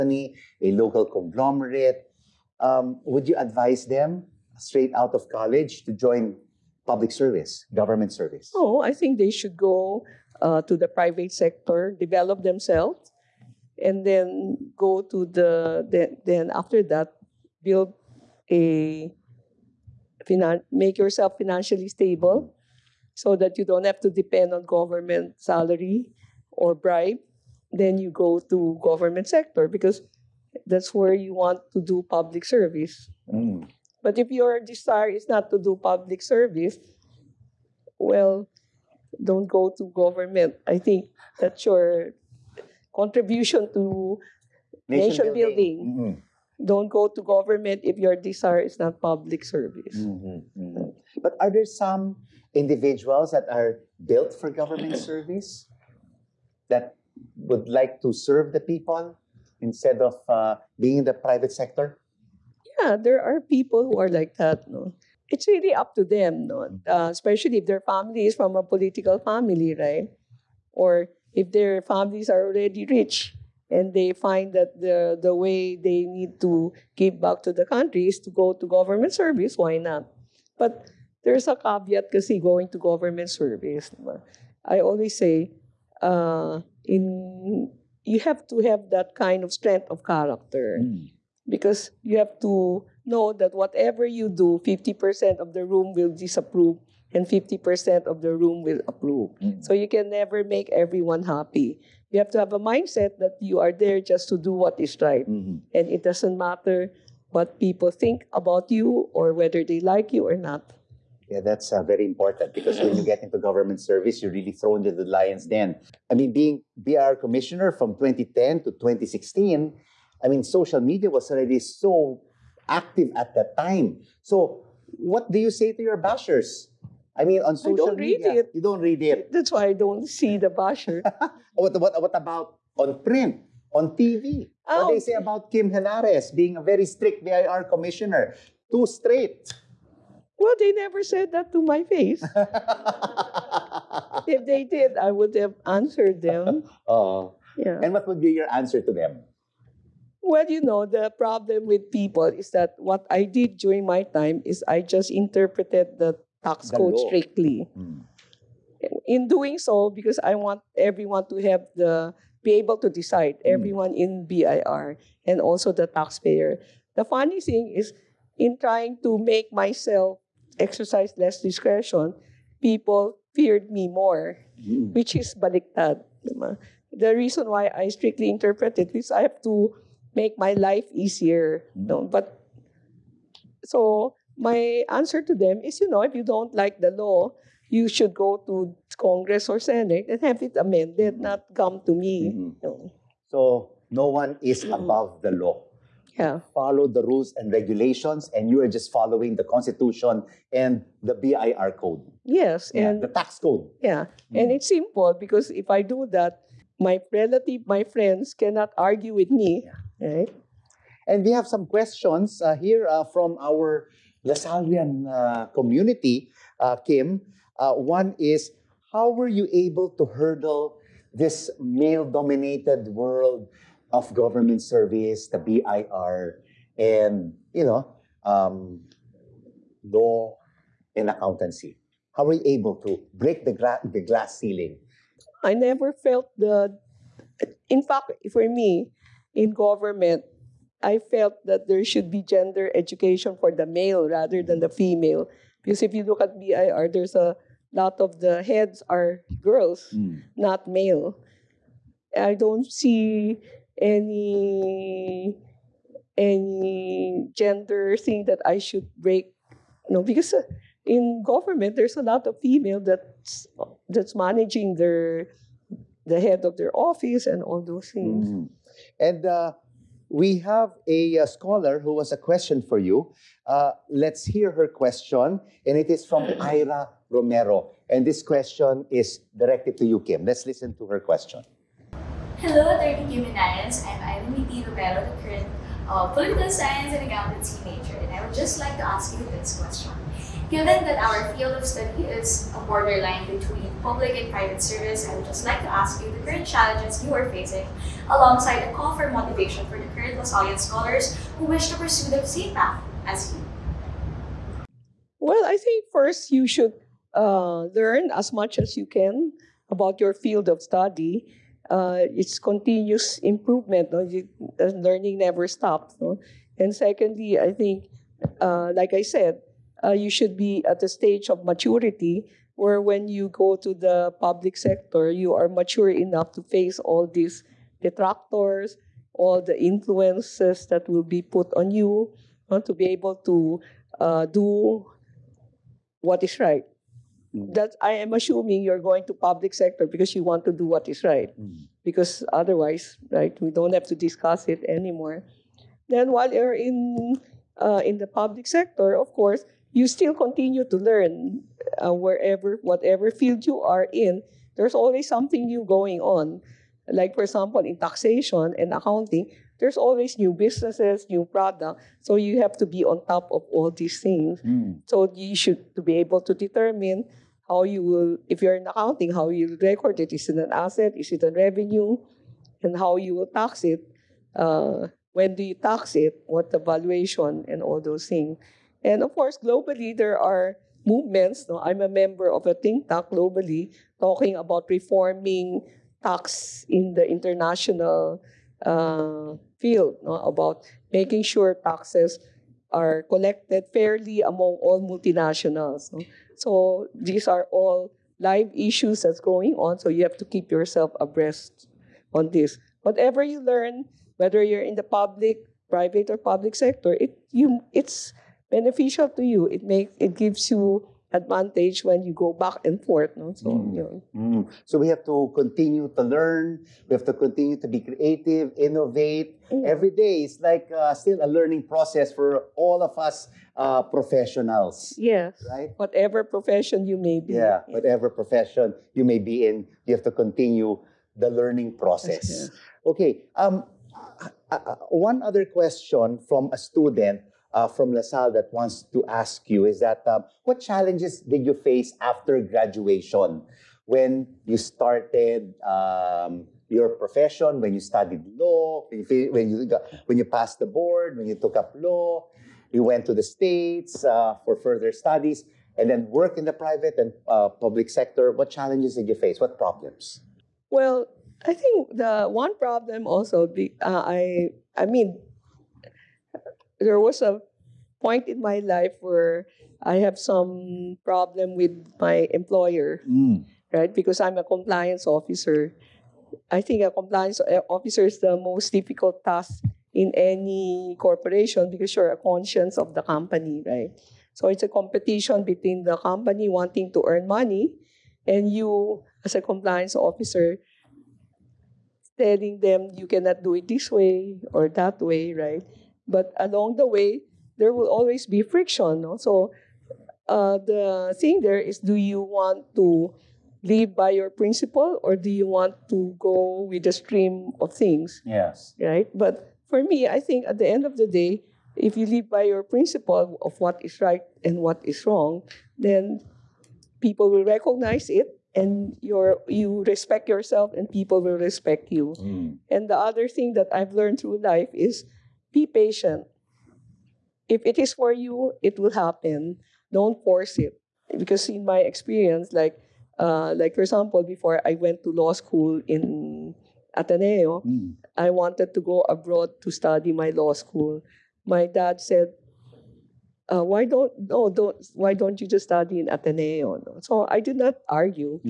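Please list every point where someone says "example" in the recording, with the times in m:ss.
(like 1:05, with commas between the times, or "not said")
5:57, 8:53.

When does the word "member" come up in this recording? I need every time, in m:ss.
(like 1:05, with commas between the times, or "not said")
6:21.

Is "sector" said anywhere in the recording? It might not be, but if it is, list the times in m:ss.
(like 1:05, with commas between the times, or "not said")
0:11, 0:29, 1:01, 5:24, 5:39, 5:48, 6:46, 7:37.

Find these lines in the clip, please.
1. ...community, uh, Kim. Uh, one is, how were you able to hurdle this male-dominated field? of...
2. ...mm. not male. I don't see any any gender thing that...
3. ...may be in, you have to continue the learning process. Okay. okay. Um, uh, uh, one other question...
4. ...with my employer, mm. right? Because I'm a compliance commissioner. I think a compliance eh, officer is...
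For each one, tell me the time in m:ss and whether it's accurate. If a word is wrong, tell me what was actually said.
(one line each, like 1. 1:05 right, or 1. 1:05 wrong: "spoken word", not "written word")
1. 3:35 wrong: "world", not "field"
2. 4:09 right
3. 7:09 right
4. 7:51 wrong: "officer", not "commissioner".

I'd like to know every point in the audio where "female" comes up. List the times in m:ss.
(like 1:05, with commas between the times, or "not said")
4:04, 4:22.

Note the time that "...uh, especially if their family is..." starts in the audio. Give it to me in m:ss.
1:06.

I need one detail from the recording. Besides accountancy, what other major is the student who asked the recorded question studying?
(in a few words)
political science.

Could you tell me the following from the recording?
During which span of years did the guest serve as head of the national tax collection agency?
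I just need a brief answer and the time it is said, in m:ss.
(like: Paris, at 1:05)
2010 to 2016, at 1:58.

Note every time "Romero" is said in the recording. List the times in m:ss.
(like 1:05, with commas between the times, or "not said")
4:37, 4:44.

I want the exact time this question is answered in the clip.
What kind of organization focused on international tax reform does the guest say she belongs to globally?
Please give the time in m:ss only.
6:22.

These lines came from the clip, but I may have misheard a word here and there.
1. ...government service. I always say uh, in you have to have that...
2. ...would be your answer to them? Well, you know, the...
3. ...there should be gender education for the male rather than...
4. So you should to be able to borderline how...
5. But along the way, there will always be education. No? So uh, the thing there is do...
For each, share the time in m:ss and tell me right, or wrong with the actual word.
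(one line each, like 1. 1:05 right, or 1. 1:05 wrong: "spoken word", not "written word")
1. 1:22 right
2. 2:28 right
3. 4:01 right
4. 6:04 wrong: "determine", not "borderline"
5. 8:16 wrong: "friction", not "education".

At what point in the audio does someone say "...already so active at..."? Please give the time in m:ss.
2:01.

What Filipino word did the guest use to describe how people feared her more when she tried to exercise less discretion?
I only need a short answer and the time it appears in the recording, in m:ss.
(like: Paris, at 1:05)
baliktad, at 2:55.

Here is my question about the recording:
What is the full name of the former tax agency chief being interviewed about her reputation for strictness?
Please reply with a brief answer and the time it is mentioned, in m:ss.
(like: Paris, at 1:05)
Kim Henares, at 2:15.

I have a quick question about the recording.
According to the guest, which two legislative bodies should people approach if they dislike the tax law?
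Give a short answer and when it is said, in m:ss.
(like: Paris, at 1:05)
Congress or Senate, at 3:08.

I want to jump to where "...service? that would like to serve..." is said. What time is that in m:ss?
0:54.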